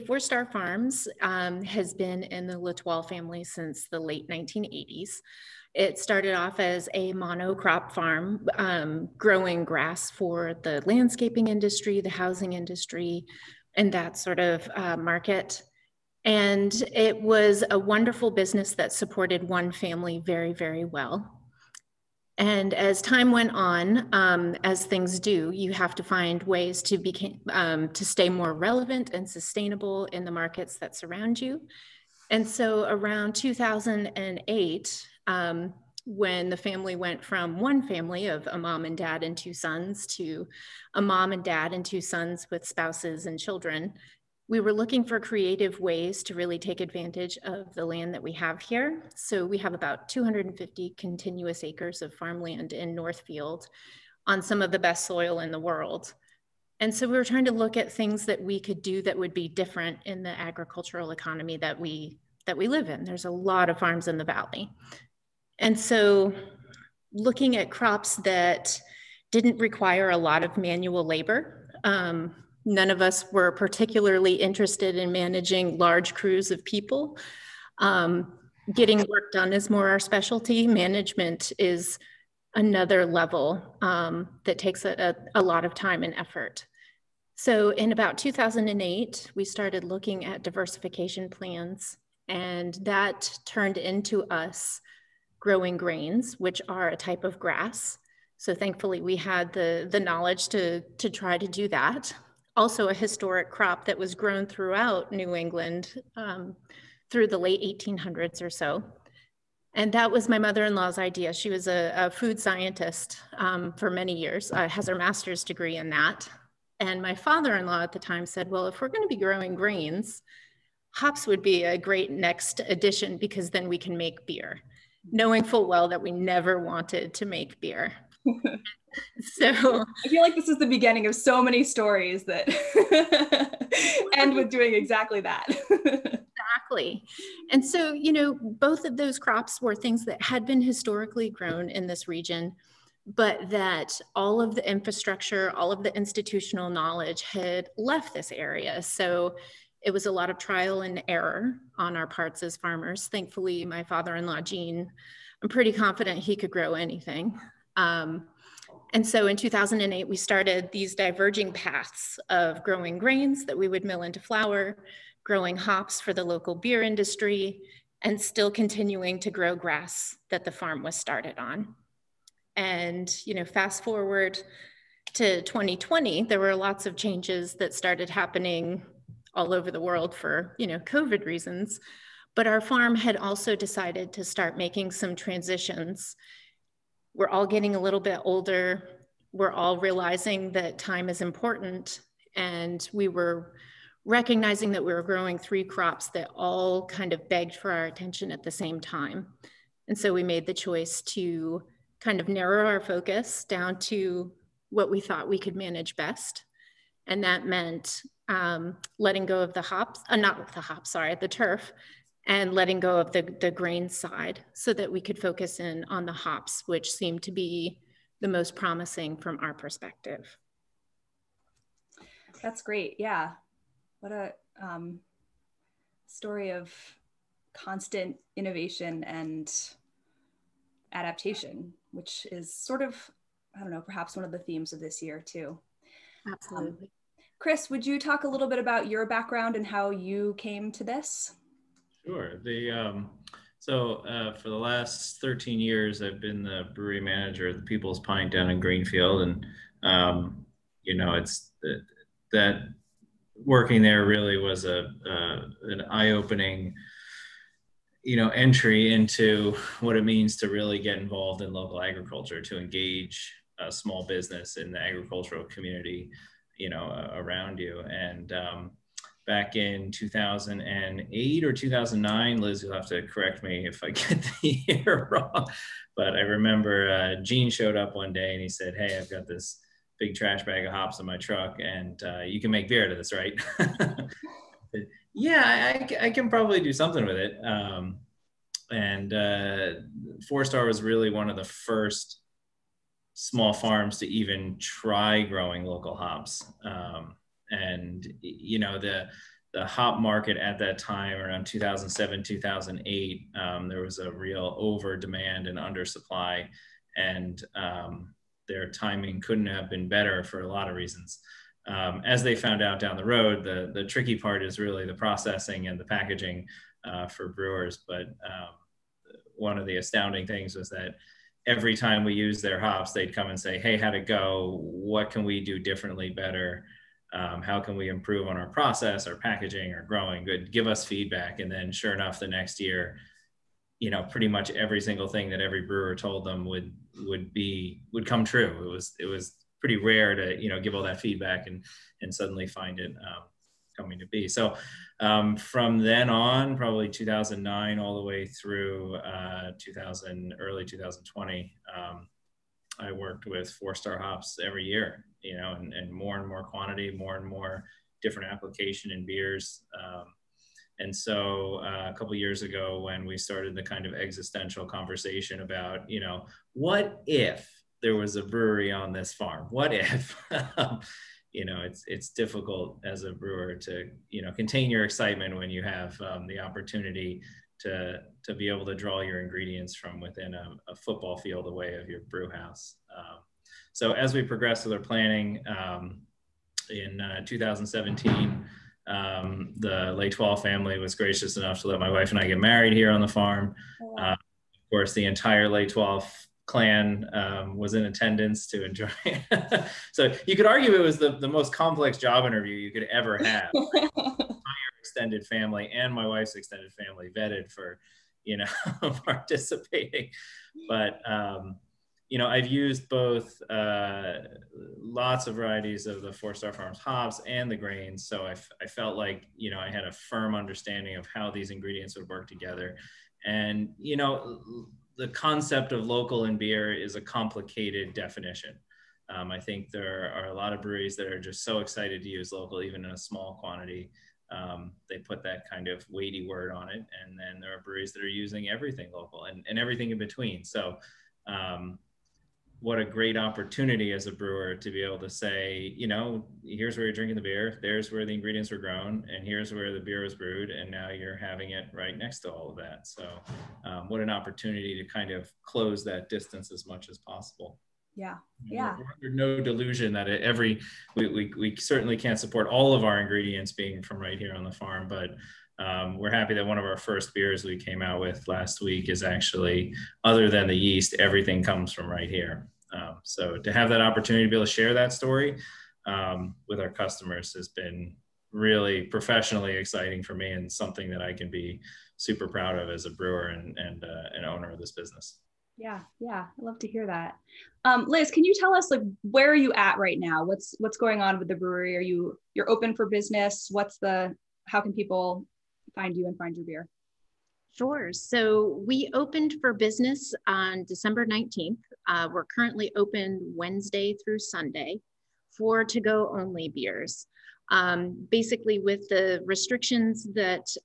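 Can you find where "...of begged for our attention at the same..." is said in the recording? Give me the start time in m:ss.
3:17.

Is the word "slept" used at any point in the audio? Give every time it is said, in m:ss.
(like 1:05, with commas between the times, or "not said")
not said.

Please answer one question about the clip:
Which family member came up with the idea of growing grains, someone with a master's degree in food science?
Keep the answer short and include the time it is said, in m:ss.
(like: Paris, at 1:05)
Mother-in-law, at 1:50.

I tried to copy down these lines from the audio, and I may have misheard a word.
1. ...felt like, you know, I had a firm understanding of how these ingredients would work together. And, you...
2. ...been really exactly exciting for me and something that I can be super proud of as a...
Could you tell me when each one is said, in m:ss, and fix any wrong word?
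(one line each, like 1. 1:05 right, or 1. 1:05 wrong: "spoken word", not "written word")
1. 6:58 right
2. 7:57 wrong: "professionally", not "exactly".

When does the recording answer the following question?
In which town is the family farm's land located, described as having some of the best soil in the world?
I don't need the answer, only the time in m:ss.
0:52.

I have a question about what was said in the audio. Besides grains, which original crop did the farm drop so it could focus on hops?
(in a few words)
Turf.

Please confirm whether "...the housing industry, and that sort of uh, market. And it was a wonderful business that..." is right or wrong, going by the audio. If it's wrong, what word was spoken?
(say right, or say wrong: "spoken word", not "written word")
right.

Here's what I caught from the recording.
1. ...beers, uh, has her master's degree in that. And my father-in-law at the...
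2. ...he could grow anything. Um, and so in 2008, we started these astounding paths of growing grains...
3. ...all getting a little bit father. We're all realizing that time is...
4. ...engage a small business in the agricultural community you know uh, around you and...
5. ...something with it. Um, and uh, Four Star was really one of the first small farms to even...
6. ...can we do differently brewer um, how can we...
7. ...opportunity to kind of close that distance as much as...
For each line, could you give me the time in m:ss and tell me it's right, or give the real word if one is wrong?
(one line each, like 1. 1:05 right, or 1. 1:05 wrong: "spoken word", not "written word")
1. 1:54 wrong: "years", not "beers"
2. 2:36 wrong: "diverging", not "astounding"
3. 3:07 wrong: "older", not "father"
4. 4:22 right
5. 4:46 right
6. 5:25 wrong: "better", not "brewer"
7. 7:34 right.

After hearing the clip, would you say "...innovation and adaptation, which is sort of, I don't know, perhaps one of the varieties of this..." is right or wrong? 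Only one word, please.
wrong.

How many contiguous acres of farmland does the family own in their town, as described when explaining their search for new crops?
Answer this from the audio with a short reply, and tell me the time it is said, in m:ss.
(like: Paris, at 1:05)
250, at 0:50.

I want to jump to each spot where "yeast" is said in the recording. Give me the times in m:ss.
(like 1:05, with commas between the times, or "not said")
7:50.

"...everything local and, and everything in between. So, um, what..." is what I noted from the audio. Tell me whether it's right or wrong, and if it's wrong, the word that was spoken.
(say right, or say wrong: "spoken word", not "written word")
right.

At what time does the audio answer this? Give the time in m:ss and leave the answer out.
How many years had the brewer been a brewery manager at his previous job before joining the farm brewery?
4:05.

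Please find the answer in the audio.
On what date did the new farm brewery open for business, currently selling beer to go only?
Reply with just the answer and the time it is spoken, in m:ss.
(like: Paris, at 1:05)
December 19, at 8:20.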